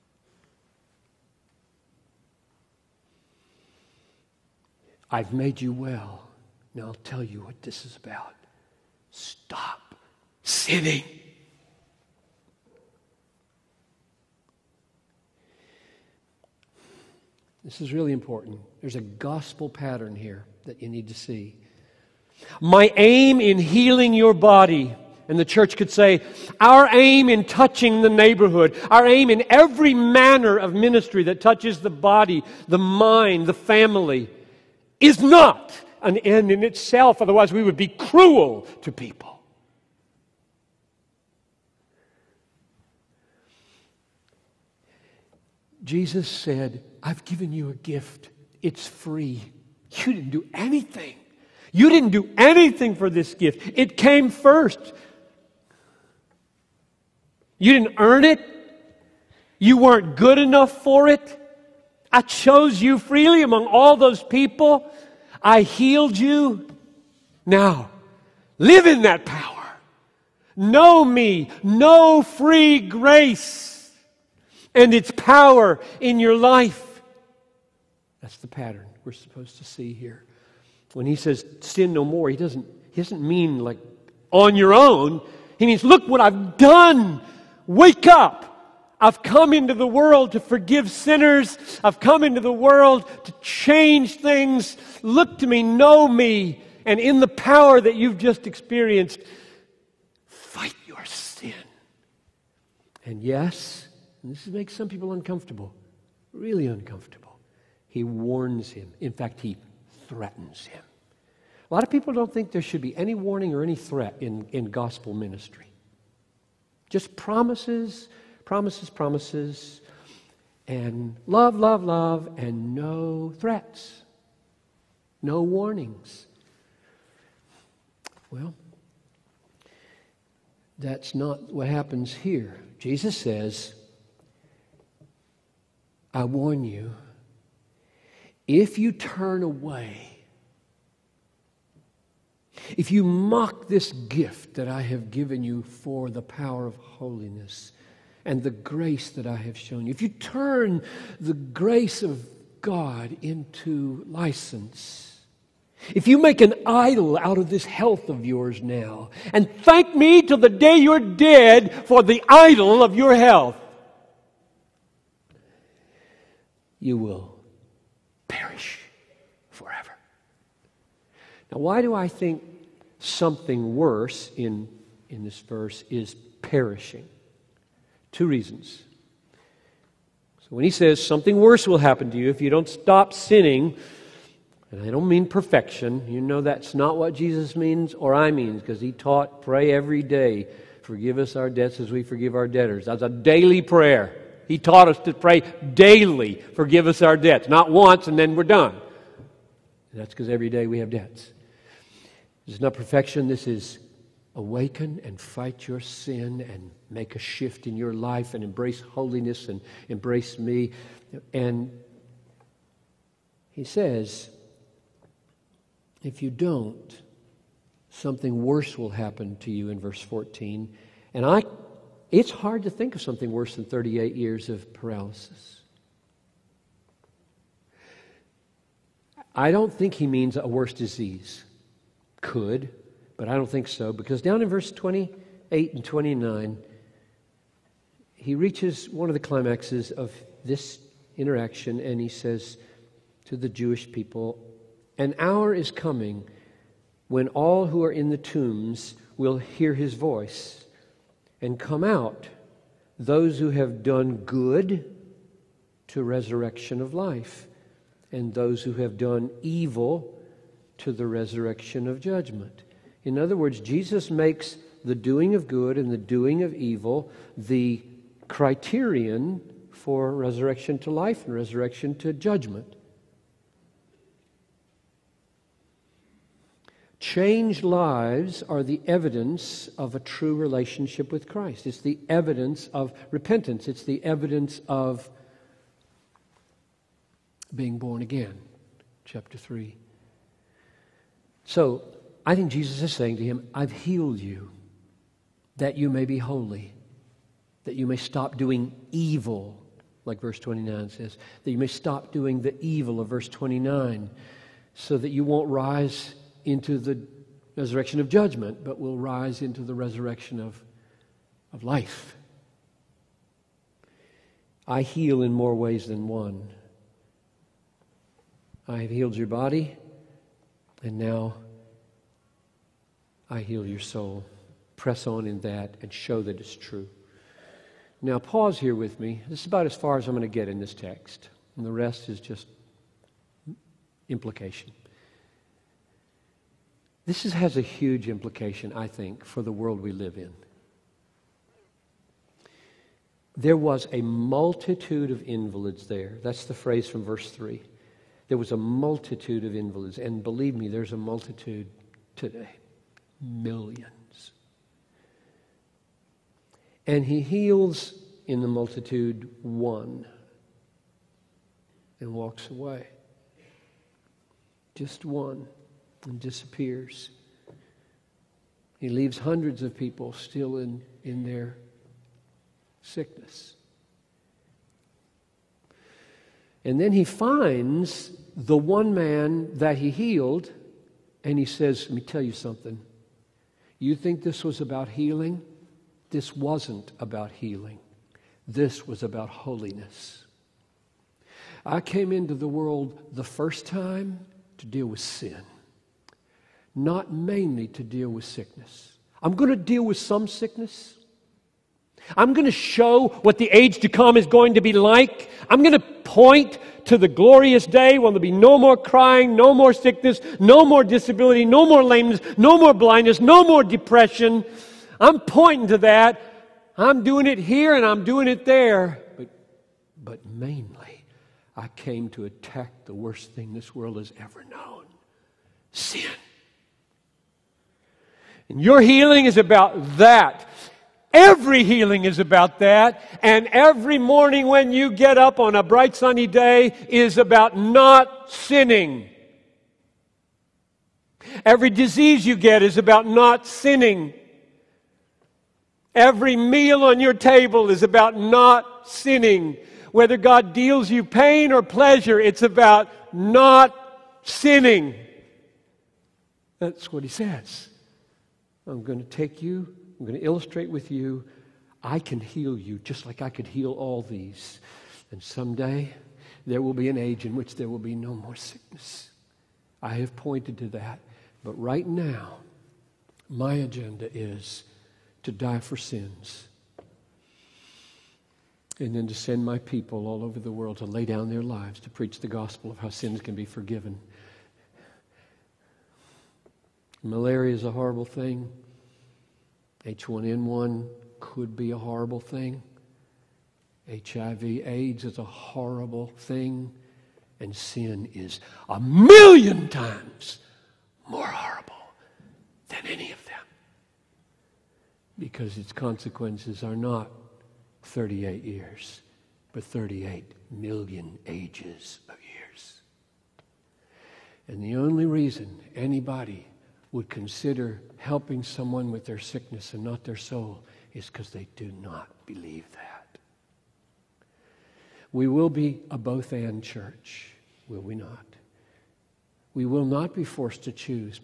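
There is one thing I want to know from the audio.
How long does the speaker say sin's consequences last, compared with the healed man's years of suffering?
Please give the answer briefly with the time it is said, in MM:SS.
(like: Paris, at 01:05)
38 million ages of years, at 08:29.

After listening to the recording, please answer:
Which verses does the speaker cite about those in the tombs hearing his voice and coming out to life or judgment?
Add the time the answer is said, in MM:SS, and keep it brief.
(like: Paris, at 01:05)
28 and 29, at 03:54.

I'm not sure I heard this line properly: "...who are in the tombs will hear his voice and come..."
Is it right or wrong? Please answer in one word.
right.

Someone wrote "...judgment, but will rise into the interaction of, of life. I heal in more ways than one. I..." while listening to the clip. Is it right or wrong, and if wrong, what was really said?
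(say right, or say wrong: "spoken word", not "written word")
wrong: "resurrection", not "interaction".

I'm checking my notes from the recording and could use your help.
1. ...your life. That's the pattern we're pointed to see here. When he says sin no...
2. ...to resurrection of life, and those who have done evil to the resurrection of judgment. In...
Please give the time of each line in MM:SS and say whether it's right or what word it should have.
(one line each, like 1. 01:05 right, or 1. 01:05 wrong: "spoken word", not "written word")
1. 01:16 wrong: "supposed", not "pointed"
2. 04:15 right.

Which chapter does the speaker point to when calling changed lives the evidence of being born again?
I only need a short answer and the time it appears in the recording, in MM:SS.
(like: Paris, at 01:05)
Chapter 3, at 04:49.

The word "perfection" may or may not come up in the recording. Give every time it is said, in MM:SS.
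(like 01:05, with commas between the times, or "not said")
03:05, 03:22.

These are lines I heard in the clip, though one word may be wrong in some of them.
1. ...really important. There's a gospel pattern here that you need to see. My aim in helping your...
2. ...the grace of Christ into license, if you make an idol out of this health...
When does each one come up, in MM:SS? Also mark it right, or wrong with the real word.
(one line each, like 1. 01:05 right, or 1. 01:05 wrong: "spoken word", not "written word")
1. 00:17 wrong: "healing", not "helping"
2. 02:31 wrong: "God", not "Christ".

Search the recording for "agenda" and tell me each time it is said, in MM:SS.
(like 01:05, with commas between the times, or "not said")
07:53.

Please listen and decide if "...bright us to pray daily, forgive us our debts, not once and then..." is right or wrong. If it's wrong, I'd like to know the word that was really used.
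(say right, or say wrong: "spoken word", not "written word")
wrong: "taught", not "bright".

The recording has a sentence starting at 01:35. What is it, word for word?
Look to me, know me, and in the power that you've just experienced, fight your sin.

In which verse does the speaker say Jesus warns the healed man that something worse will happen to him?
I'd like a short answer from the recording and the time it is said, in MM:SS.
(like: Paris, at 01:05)
verse 14, at 03:39.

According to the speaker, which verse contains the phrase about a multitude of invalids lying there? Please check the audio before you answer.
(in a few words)
verse 3.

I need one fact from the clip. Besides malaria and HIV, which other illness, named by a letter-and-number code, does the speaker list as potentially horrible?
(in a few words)
H1N1.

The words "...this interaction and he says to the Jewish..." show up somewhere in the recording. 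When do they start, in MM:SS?
04:00.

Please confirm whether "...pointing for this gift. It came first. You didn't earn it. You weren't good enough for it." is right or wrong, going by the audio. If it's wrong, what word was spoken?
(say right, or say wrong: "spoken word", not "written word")
wrong: "anything", not "pointing".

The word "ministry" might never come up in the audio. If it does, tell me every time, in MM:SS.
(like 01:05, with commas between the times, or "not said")
00:30, 01:55.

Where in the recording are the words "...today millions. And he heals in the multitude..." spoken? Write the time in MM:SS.
05:52.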